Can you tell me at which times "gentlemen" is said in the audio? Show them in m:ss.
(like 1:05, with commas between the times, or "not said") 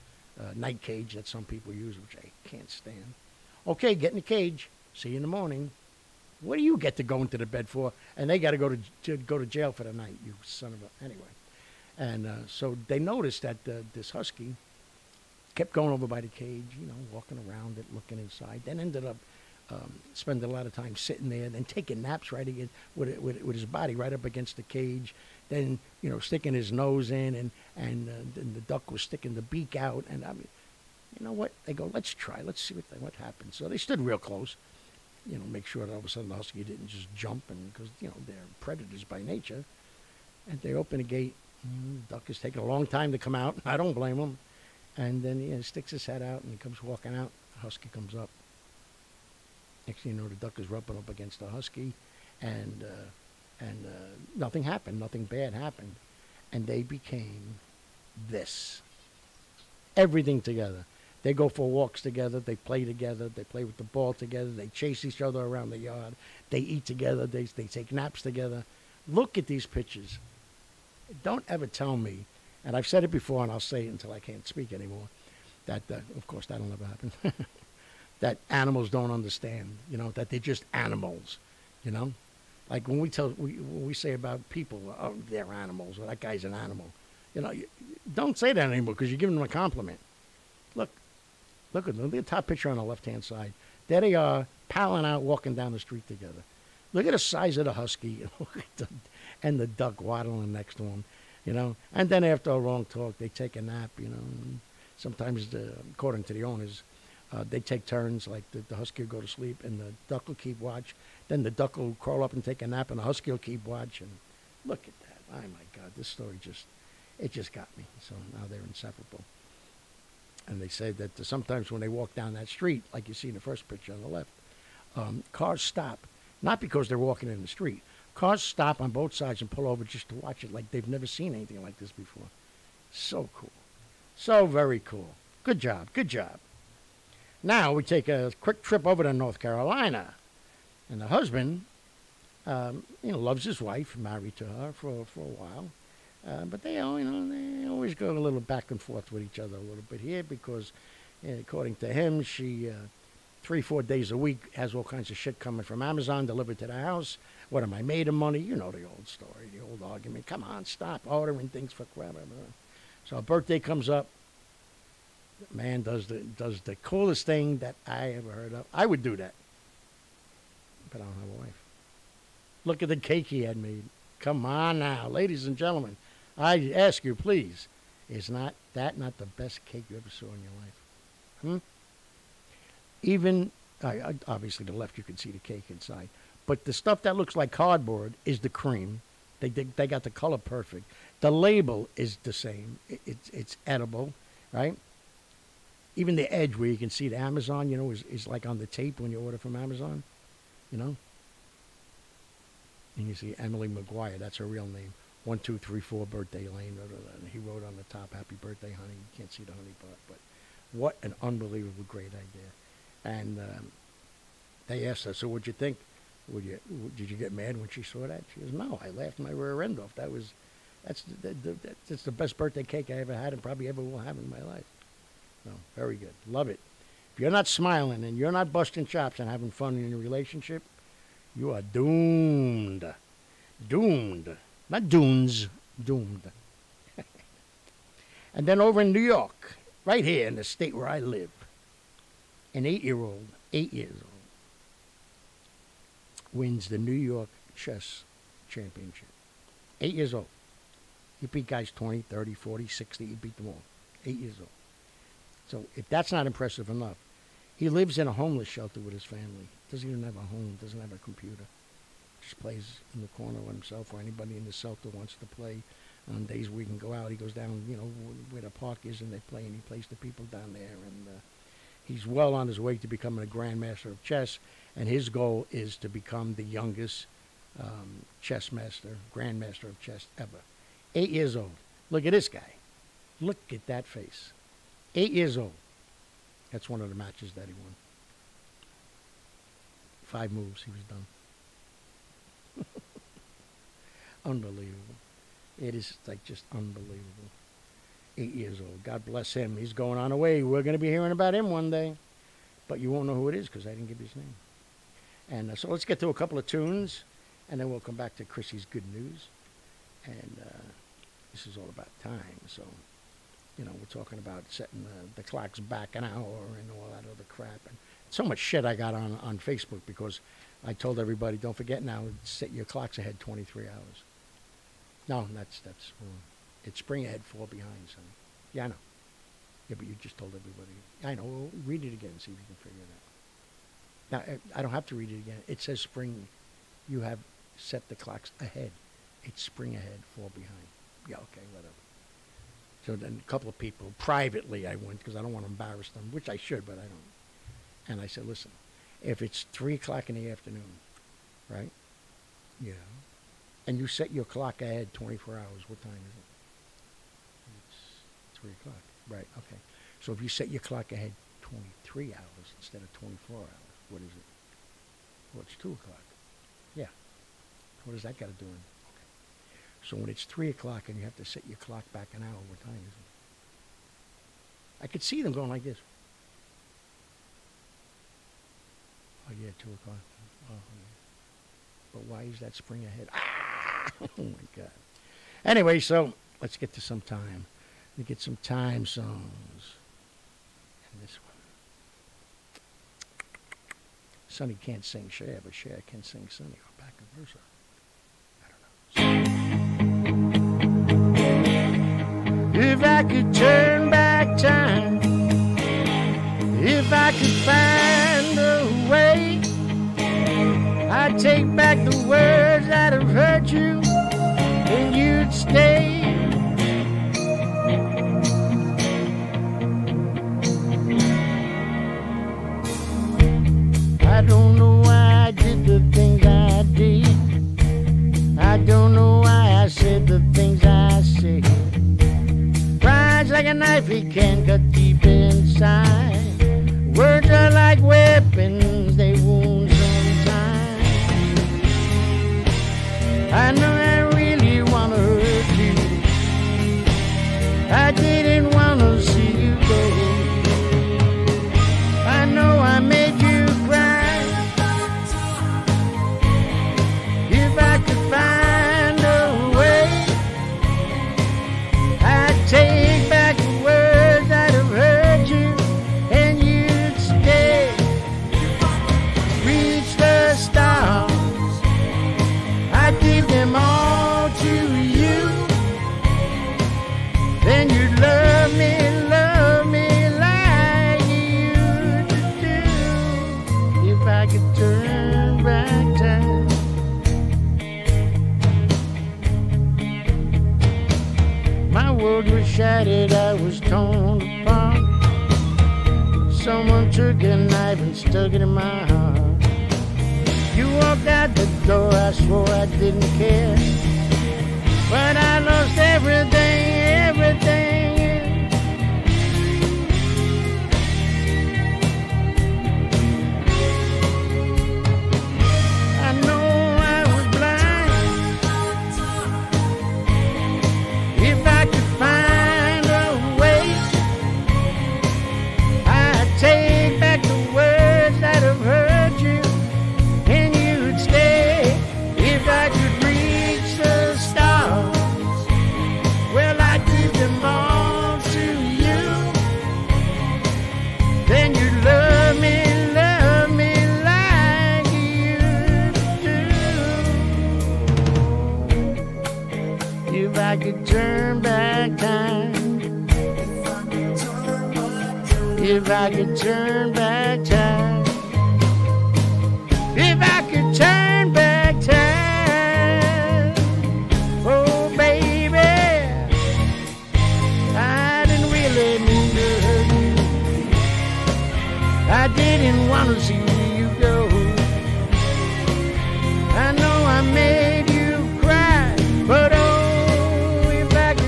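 2:55.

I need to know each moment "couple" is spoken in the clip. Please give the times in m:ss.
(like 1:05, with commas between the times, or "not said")
5:06, 5:43.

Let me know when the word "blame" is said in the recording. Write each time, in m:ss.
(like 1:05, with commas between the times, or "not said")
0:43.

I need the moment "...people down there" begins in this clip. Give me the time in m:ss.
4:29.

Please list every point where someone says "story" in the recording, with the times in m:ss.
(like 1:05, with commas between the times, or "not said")
1:56, 2:39.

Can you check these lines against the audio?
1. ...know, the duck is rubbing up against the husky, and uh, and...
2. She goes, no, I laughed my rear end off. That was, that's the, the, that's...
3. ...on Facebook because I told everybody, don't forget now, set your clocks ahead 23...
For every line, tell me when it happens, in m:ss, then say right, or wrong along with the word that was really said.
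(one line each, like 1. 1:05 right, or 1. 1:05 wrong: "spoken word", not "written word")
1. 0:50 right
2. 3:38 right
3. 5:19 right.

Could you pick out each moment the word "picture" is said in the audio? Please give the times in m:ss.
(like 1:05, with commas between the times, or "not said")
1:09, 1:32, 2:03.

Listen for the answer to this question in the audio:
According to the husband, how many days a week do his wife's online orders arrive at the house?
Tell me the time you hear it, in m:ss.
2:33.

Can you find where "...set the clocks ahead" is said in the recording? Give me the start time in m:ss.
5:37.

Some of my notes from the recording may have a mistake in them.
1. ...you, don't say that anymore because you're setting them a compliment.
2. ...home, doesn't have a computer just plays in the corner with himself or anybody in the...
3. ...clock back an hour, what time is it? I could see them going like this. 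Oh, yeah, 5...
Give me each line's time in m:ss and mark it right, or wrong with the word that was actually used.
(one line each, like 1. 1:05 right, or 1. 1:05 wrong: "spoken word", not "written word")
1. 1:27 wrong: "giving", not "setting"
2. 4:20 right
3. 6:11 wrong: "2", not "5".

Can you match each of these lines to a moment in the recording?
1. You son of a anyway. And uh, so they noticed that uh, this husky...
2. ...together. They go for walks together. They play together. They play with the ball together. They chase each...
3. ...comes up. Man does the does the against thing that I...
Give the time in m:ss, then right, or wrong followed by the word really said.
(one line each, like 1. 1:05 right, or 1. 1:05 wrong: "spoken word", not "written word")
1. 0:10 right
2. 1:00 right
3. 2:43 wrong: "coolest", not "against".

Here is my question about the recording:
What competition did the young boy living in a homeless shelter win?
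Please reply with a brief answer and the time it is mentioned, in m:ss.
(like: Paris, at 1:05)
New York Chess Championship, at 4:06.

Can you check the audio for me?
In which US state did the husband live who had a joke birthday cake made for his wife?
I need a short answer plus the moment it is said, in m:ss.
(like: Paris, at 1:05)
North Carolina, at 2:19.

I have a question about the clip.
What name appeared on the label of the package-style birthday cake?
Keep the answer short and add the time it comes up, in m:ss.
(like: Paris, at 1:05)
Emily McGuire, at 3:23.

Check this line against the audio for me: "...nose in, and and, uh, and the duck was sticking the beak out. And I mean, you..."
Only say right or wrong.
right.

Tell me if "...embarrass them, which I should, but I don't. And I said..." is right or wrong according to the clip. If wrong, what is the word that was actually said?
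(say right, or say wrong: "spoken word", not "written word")
right.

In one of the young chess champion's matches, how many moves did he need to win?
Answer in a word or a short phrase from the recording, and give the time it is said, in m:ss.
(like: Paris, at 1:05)
5, at 4:50.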